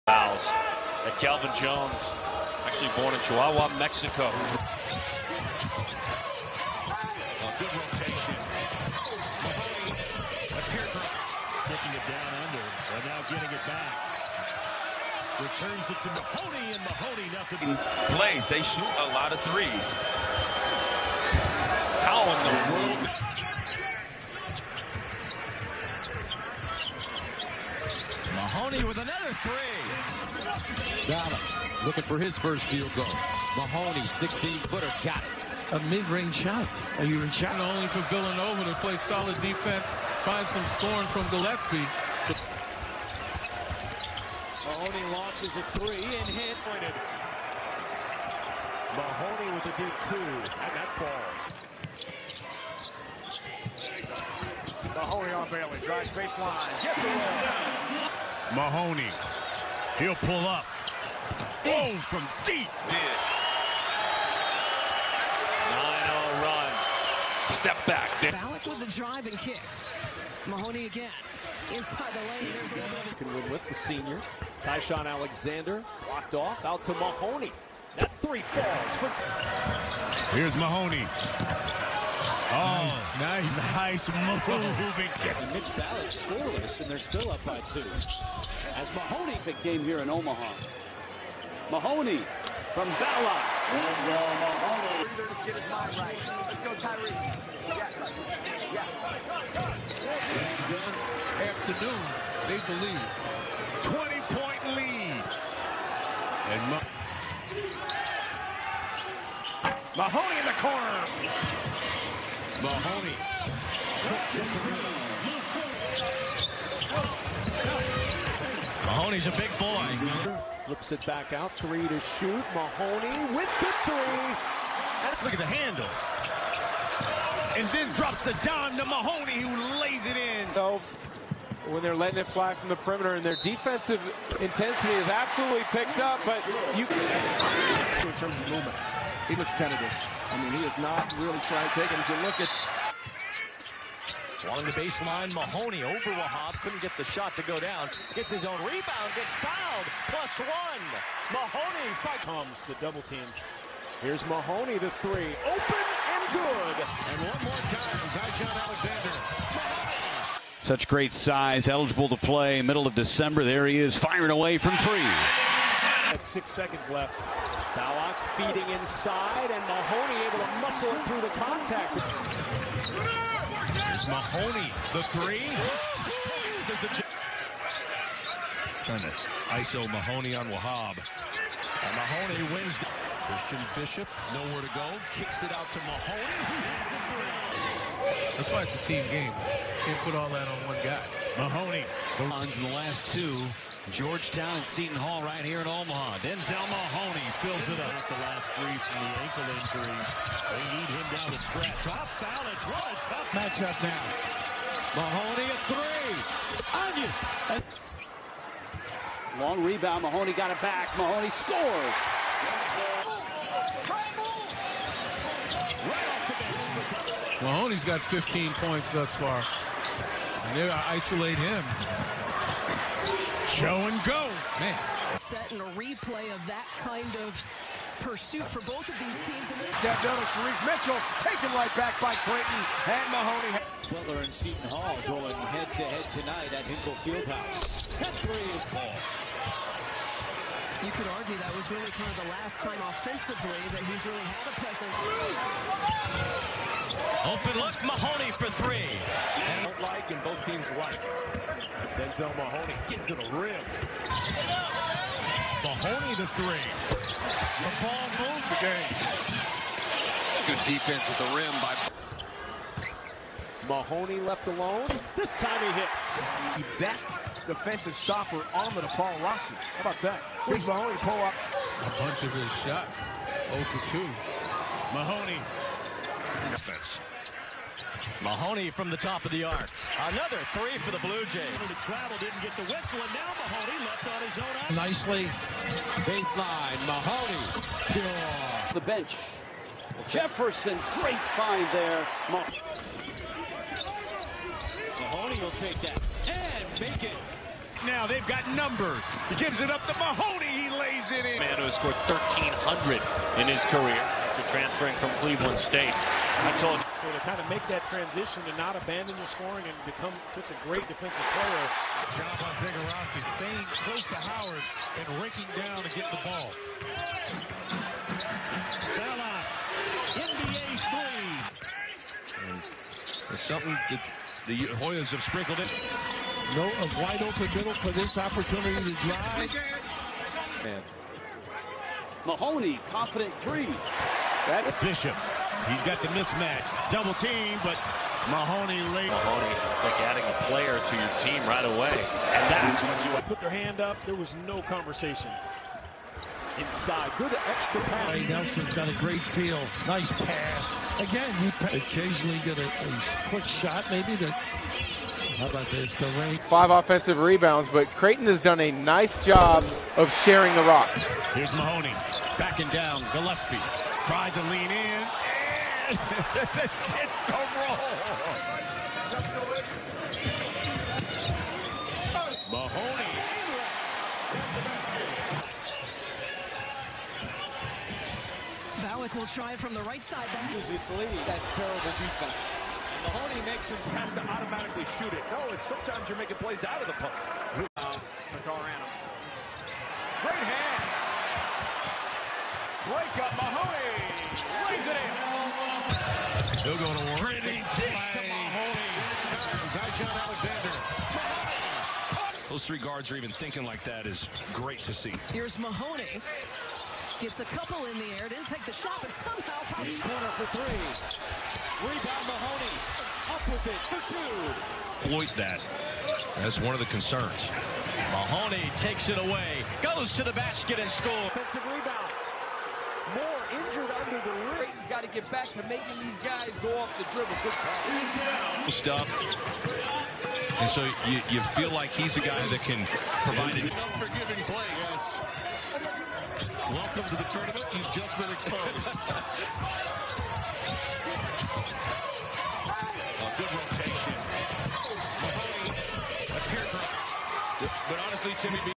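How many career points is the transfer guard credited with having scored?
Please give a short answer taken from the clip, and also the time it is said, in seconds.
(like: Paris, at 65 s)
1,300, at 302 s.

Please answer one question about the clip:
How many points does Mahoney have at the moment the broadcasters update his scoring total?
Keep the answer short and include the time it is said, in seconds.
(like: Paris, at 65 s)
15, at 218 s.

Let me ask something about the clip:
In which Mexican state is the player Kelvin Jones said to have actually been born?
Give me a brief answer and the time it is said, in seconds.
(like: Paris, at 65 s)
Chihuahua, at 3 s.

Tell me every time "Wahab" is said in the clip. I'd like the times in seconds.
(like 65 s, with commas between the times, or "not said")
145 s, 180 s.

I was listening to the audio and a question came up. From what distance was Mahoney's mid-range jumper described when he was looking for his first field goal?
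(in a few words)
16 feet.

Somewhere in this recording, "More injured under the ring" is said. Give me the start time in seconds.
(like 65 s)
423 s.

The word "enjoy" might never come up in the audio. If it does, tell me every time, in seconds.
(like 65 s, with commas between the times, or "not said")
not said.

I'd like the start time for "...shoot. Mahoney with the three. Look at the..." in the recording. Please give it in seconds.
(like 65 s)
121 s.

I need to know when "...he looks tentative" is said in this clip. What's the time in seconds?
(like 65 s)
139 s.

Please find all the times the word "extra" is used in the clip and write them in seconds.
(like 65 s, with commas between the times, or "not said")
347 s.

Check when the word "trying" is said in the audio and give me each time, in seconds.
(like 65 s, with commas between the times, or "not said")
141 s, 178 s.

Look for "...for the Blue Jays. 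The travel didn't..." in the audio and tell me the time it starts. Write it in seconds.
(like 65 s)
280 s.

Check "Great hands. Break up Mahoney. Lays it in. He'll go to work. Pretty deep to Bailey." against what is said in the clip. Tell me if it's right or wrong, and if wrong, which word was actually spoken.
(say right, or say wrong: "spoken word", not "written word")
wrong: "Mahoney", not "Bailey".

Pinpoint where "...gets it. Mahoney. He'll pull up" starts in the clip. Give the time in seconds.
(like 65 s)
56 s.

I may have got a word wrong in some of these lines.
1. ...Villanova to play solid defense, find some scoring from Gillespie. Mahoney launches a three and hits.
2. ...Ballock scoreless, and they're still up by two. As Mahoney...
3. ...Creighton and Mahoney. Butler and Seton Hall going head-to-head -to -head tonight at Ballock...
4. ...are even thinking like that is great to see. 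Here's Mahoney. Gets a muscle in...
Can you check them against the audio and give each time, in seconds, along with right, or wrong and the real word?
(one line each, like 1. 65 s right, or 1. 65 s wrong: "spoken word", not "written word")
1. 38 s right
2. 85 s right
3. 232 s wrong: "Hinkle", not "Ballock"
4. 403 s wrong: "couple", not "muscle".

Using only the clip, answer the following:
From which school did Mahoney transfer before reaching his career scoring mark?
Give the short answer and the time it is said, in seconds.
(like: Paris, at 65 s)
Cleveland State, at 305 s.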